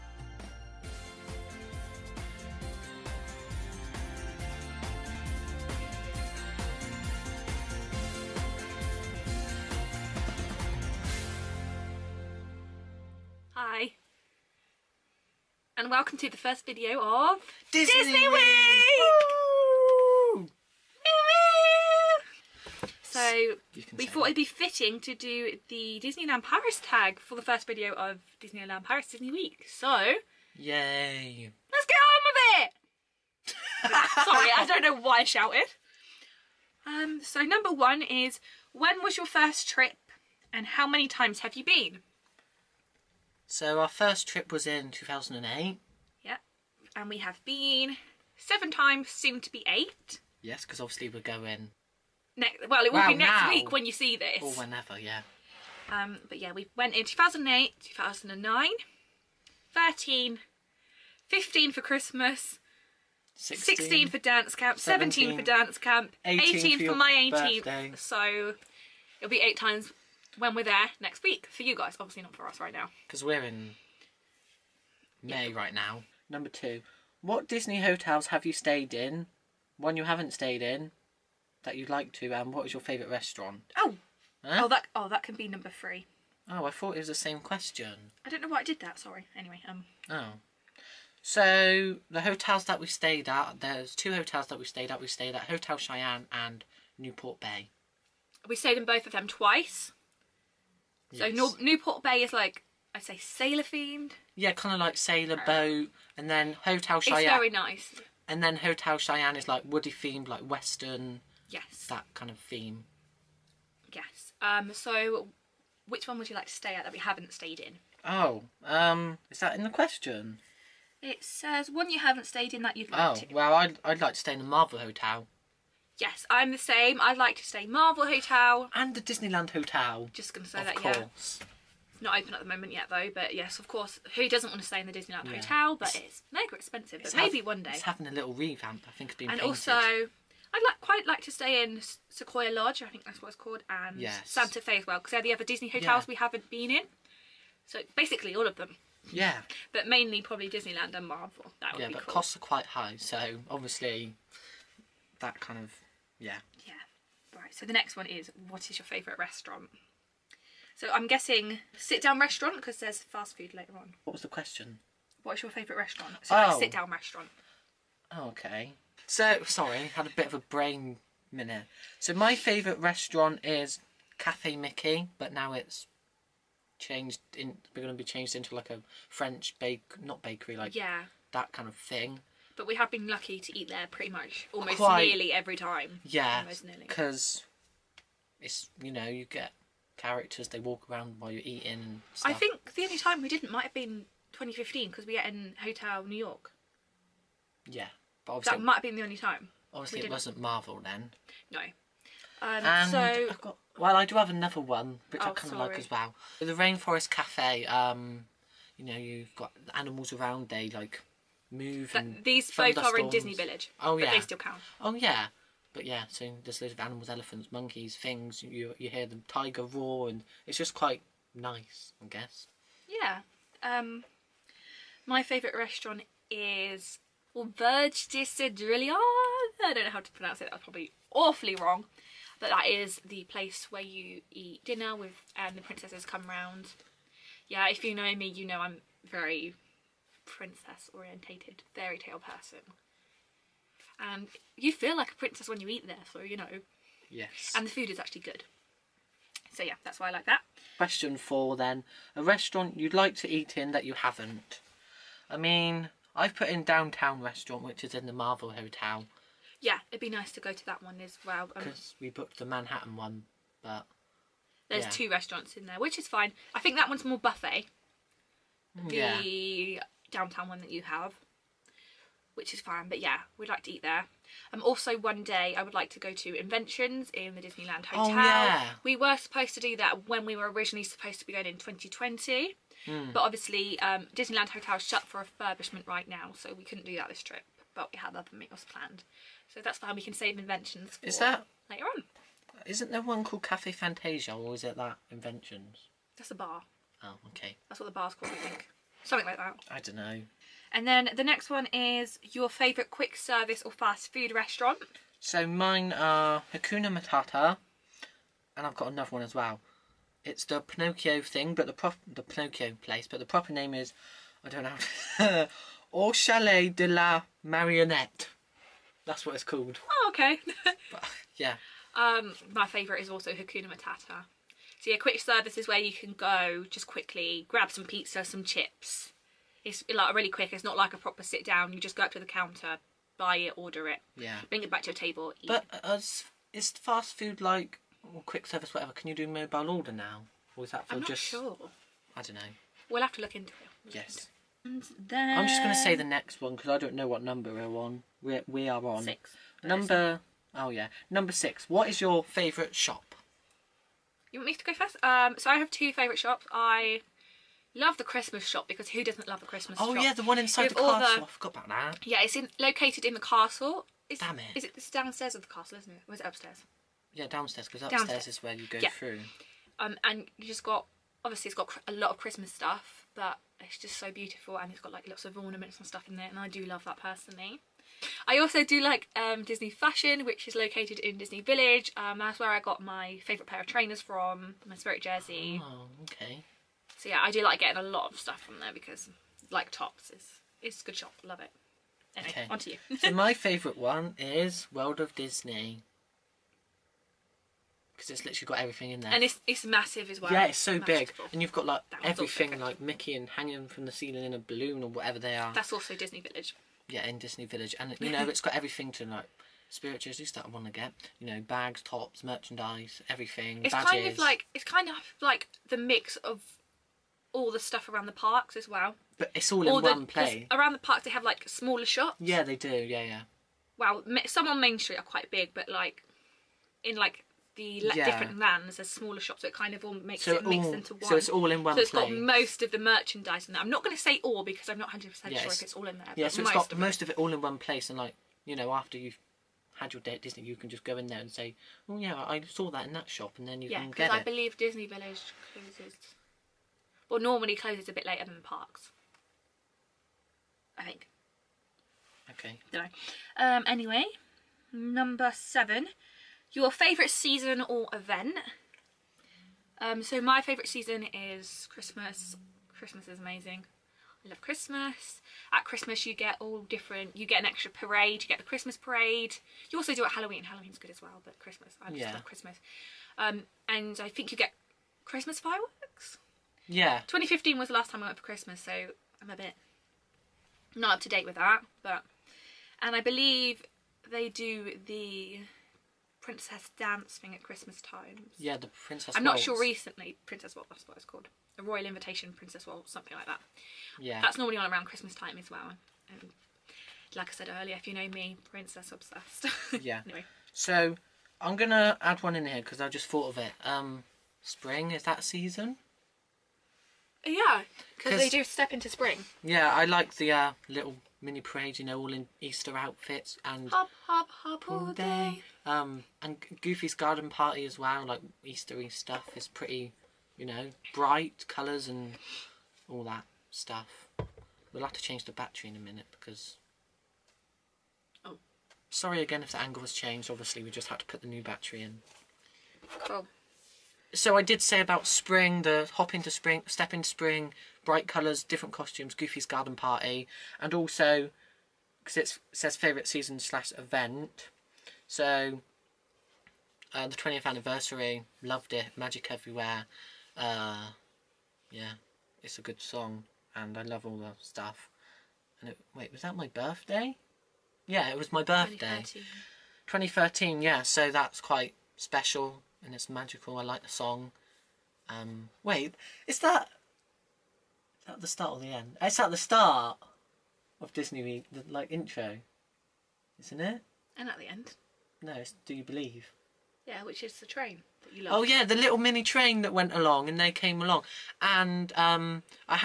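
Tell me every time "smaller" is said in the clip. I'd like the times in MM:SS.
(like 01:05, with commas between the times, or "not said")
07:01, 07:08.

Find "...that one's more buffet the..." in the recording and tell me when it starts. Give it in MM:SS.
04:26.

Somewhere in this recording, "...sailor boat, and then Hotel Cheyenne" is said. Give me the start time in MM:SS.
01:44.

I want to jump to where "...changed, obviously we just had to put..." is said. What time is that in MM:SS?
08:49.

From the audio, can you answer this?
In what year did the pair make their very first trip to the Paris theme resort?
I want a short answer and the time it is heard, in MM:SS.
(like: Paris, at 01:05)
2008, at 00:43.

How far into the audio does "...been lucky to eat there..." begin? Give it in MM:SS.
03:02.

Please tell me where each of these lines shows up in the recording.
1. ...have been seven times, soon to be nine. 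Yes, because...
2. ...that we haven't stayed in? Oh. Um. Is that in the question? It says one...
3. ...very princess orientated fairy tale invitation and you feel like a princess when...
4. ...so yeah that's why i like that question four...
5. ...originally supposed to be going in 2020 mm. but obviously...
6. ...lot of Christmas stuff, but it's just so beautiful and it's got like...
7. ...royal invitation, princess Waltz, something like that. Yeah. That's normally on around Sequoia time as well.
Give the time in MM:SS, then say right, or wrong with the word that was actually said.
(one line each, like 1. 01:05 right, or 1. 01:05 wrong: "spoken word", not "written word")
1. 00:47 wrong: "eight", not "nine"
2. 01:56 right
3. 03:59 wrong: "person", not "invitation"
4. 04:09 right
5. 04:40 right
6. 06:11 right
7. 08:11 wrong: "Christmas", not "Sequoia".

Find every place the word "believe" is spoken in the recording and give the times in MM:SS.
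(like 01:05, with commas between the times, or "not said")
07:24, 08:03, 09:35.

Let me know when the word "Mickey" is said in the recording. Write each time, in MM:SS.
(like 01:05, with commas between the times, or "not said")
02:54, 06:42.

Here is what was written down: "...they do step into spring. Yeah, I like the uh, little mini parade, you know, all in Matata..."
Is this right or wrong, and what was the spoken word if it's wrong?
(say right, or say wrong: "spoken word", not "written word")
wrong: "Easter", not "Matata".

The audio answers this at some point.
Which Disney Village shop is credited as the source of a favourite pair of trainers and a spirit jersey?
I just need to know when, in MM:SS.
06:19.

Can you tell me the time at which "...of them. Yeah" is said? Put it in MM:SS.
02:28.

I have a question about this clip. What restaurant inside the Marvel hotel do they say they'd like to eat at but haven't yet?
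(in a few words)
Downtown restaurant.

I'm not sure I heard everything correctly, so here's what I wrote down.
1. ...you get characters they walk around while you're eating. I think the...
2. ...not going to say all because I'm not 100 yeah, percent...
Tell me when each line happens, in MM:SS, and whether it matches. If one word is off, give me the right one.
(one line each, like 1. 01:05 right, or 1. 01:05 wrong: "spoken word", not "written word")
1. 03:09 right
2. 07:13 right.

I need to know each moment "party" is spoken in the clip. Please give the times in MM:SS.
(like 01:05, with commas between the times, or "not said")
08:37, 08:59.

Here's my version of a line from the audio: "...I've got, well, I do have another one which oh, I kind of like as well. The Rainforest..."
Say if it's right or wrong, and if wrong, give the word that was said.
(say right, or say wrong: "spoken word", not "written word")
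right.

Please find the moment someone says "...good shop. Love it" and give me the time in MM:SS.
06:30.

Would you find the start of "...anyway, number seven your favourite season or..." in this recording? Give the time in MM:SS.
07:33.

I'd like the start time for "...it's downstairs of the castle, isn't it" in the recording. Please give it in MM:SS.
06:04.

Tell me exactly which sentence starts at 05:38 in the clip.
Can you do mobile order now, or is that for I'm just?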